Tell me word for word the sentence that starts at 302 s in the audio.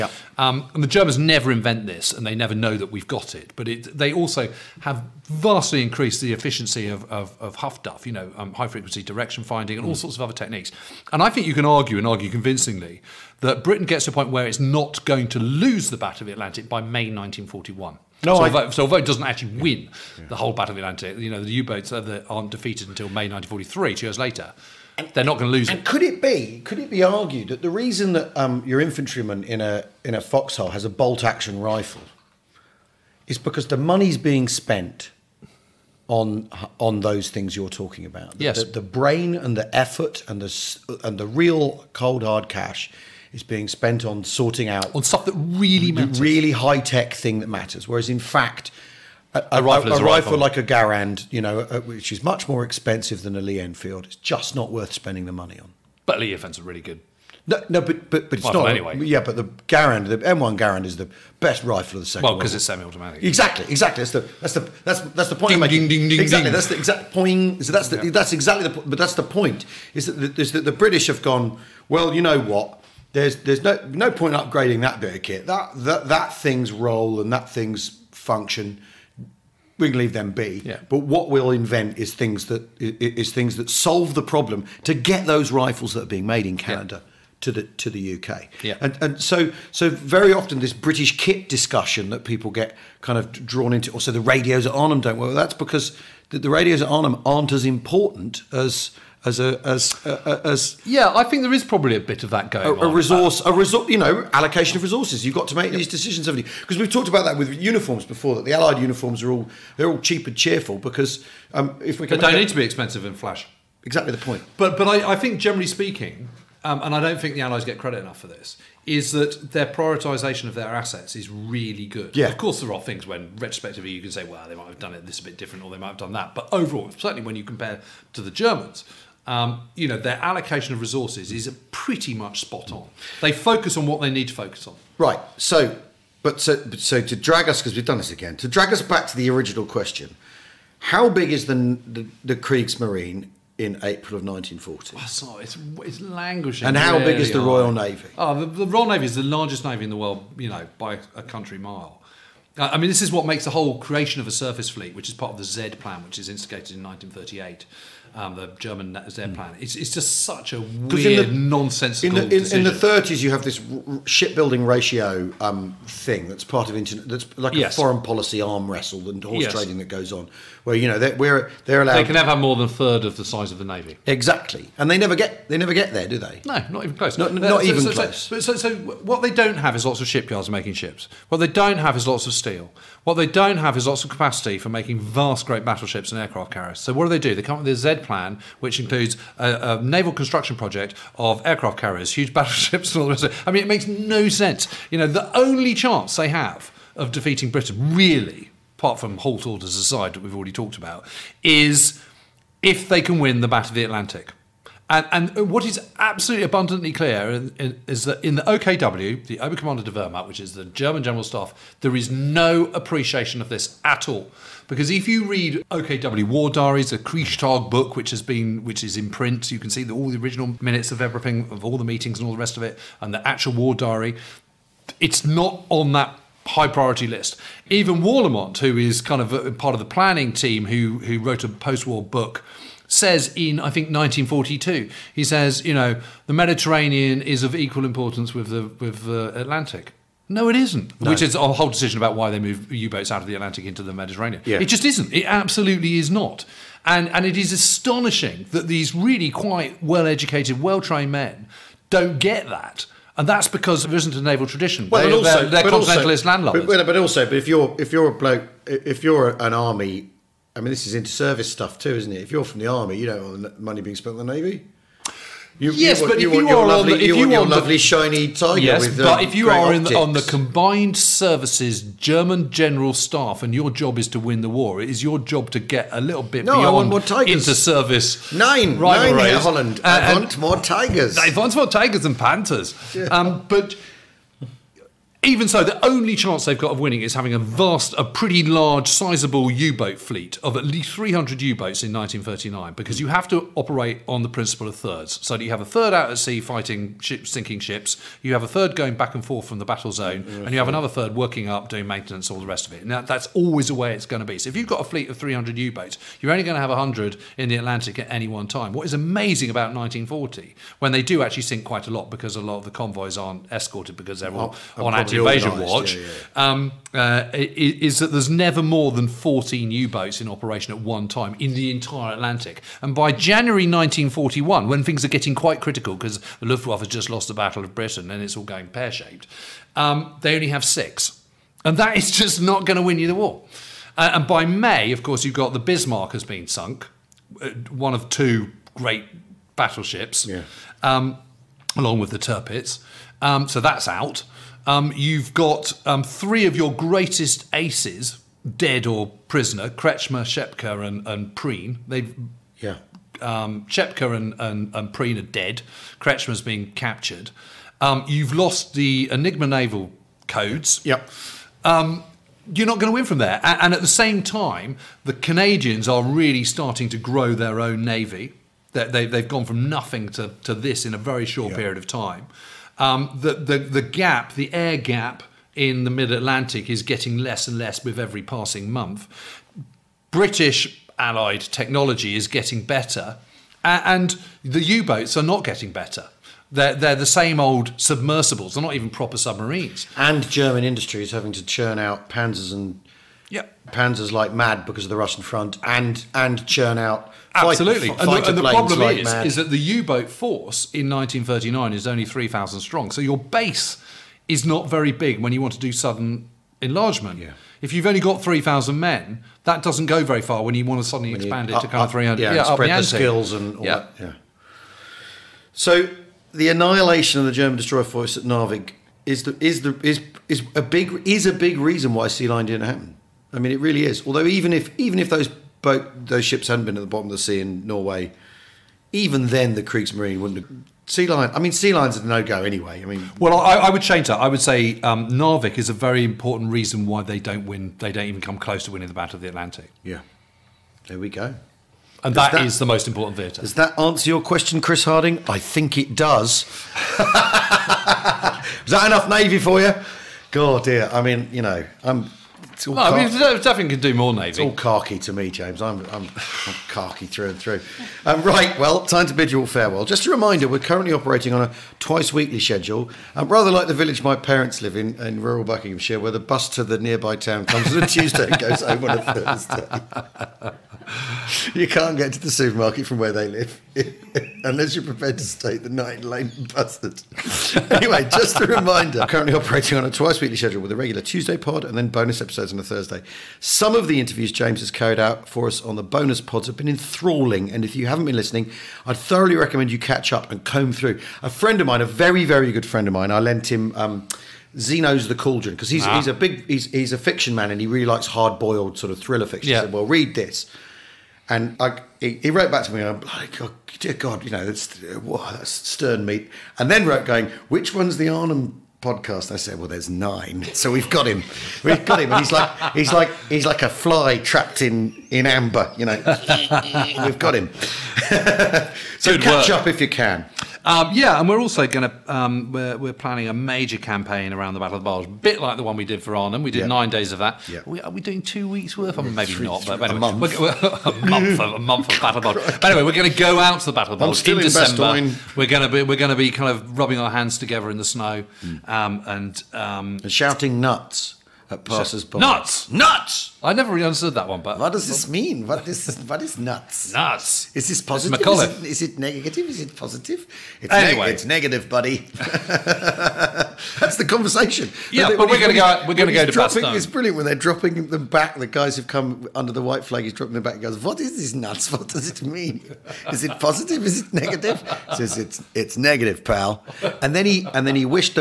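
Now, that's always the way it's going to be.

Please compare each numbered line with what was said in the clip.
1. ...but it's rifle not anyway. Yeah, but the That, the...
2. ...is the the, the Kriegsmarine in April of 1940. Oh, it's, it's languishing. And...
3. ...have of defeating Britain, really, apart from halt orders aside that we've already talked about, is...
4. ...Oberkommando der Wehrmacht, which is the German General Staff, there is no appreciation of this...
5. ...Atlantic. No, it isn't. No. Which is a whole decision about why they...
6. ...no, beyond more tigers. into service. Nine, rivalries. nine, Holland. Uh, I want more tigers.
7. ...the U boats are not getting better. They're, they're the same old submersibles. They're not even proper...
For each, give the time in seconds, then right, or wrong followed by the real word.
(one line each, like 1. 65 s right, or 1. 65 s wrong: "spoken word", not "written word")
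1. 58 s wrong: "Garand", not "That"
2. 141 s right
3. 196 s right
4. 209 s right
5. 239 s right
6. 276 s right
7. 384 s right.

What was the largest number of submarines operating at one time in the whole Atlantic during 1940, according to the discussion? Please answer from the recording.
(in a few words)
14.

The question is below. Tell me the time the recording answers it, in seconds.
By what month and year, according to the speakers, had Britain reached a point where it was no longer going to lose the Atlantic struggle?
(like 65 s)
16 s.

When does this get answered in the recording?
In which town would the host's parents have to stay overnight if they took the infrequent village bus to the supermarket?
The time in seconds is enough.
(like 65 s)
476 s.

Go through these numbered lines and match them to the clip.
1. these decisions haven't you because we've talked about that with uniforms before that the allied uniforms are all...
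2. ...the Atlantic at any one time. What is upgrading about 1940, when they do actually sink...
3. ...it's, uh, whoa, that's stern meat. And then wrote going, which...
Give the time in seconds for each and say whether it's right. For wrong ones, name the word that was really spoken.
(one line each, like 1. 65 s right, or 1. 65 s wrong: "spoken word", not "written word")
1. 105 s right
2. 307 s wrong: "amazing", not "upgrading"
3. 504 s right.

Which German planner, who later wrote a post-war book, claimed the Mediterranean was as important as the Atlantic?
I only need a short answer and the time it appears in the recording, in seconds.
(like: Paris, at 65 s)
Warlimont, at 227 s.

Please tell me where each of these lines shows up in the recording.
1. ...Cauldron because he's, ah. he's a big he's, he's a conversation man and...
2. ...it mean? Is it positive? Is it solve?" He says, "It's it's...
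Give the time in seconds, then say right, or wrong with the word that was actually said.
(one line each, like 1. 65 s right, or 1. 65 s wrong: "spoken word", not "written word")
1. 495 s wrong: "fiction", not "conversation"
2. 562 s wrong: "negative", not "solve".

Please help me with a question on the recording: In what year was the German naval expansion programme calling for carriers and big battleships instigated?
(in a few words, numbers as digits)
1938.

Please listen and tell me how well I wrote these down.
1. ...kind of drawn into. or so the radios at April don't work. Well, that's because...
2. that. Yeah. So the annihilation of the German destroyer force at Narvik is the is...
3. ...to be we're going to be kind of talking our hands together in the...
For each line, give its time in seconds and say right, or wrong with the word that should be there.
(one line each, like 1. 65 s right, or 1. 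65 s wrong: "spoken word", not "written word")
1. 93 s wrong: "Arnhem", not "April"
2. 413 s right
3. 535 s wrong: "rubbing", not "talking".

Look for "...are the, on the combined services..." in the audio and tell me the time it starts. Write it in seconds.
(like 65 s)
269 s.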